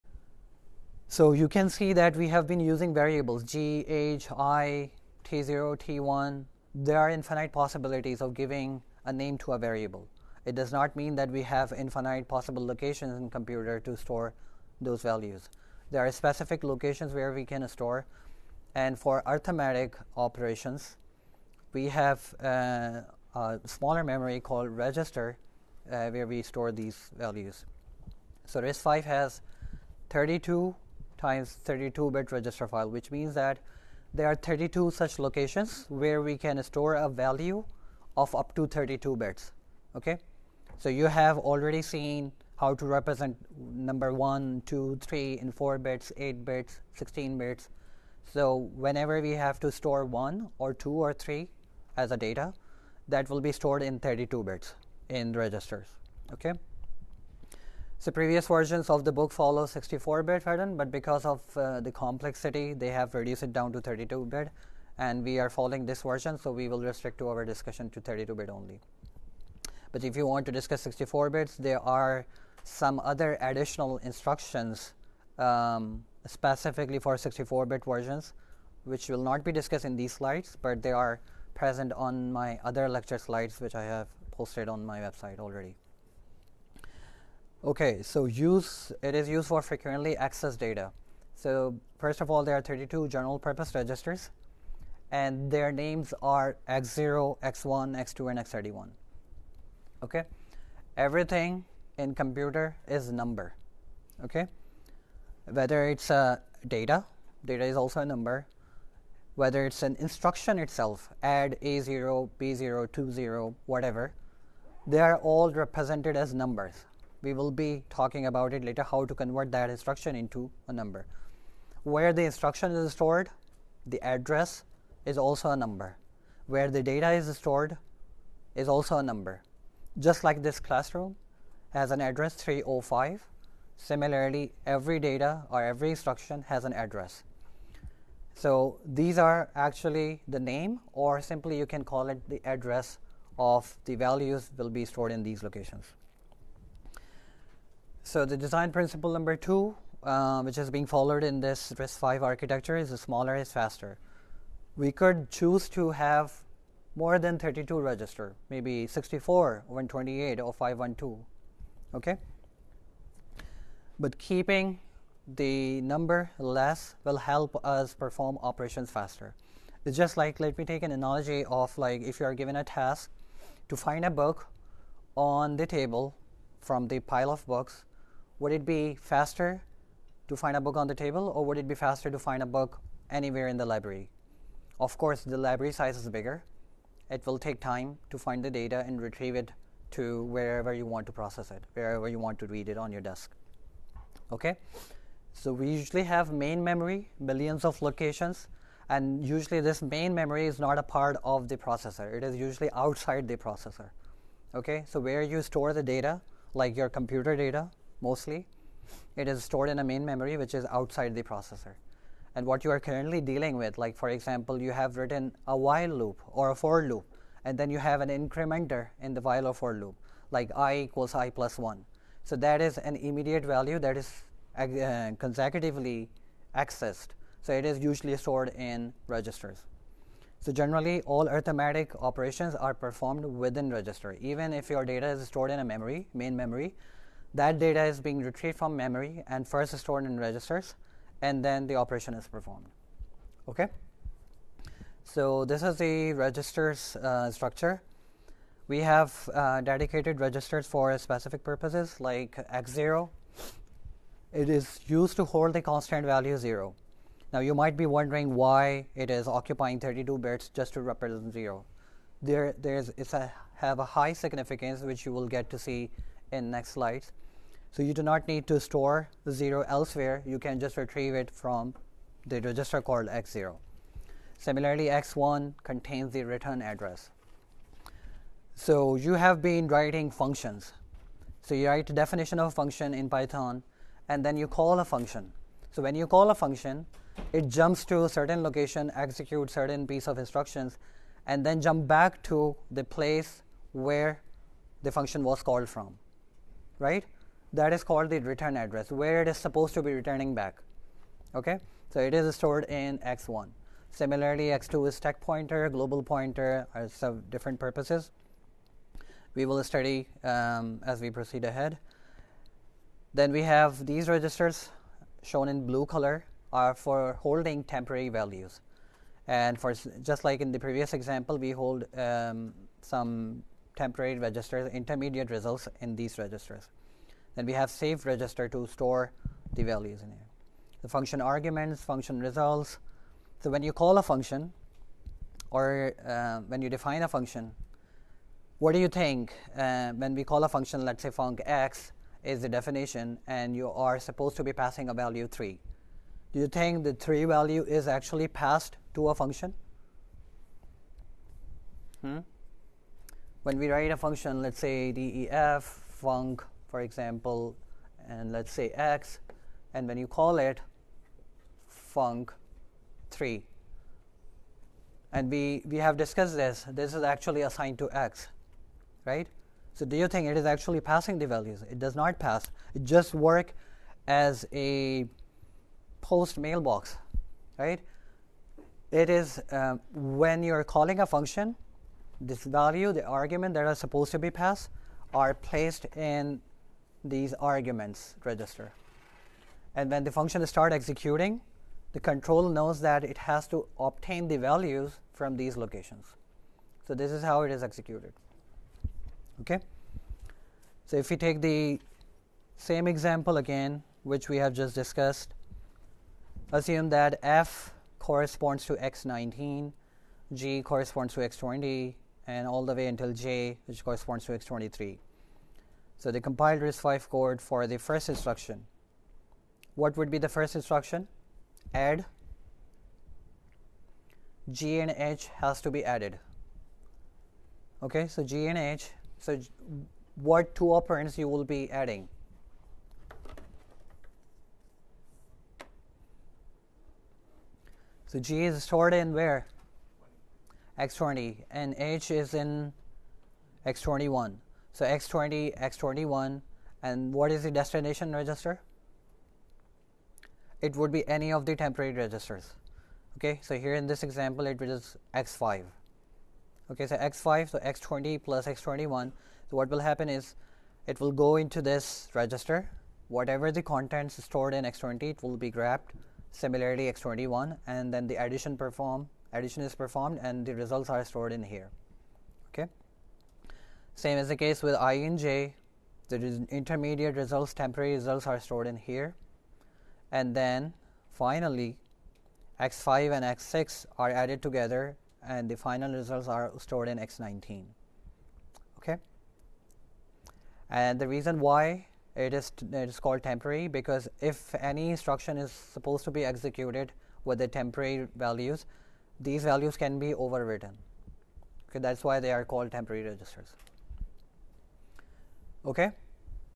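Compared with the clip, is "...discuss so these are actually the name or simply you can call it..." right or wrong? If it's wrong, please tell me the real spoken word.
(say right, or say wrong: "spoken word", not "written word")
wrong: "address", not "discuss".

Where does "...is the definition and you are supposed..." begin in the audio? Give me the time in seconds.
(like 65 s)
342 s.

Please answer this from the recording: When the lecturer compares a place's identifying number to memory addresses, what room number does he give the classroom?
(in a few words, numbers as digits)
305.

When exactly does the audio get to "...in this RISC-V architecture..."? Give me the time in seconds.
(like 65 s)
151 s.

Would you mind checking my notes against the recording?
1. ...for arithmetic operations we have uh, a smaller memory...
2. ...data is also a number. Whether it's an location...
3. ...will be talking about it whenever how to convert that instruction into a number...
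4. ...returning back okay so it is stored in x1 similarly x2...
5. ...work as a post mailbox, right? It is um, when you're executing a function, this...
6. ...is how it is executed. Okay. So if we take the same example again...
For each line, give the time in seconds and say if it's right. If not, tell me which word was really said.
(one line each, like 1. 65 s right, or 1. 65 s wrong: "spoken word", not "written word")
1. 18 s right
2. 107 s wrong: "instruction", not "location"
3. 117 s wrong: "later", not "whenever"
4. 299 s right
5. 373 s wrong: "calling", not "executing"
6. 397 s right.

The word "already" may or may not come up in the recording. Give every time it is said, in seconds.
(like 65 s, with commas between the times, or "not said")
41 s, 85 s.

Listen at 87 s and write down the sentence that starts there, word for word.
Okay, so use it is used for frequently accessed data.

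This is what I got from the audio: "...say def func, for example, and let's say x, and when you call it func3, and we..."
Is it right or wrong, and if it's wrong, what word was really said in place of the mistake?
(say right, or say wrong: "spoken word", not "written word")
right.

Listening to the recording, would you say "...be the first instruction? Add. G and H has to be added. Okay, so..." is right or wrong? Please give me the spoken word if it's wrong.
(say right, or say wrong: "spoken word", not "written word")
right.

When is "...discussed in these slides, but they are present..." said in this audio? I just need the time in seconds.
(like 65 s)
79 s.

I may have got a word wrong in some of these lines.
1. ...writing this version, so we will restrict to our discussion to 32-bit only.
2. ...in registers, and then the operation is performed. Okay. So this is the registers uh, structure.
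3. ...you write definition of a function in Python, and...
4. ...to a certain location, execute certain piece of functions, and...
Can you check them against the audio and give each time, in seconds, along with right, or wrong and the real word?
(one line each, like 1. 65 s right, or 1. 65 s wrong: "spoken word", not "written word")
1. 65 s wrong: "following", not "writing"
2. 240 s right
3. 281 s right
4. 287 s wrong: "instructions", not "functions".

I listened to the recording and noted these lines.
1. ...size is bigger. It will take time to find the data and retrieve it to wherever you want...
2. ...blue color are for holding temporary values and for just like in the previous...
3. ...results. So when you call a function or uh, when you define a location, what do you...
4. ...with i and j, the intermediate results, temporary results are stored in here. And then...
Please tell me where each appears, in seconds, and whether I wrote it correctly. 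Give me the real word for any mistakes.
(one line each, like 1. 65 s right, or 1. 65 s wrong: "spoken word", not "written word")
1. 185 s right
2. 315 s right
3. 332 s wrong: "function", not "location"
4. 474 s right.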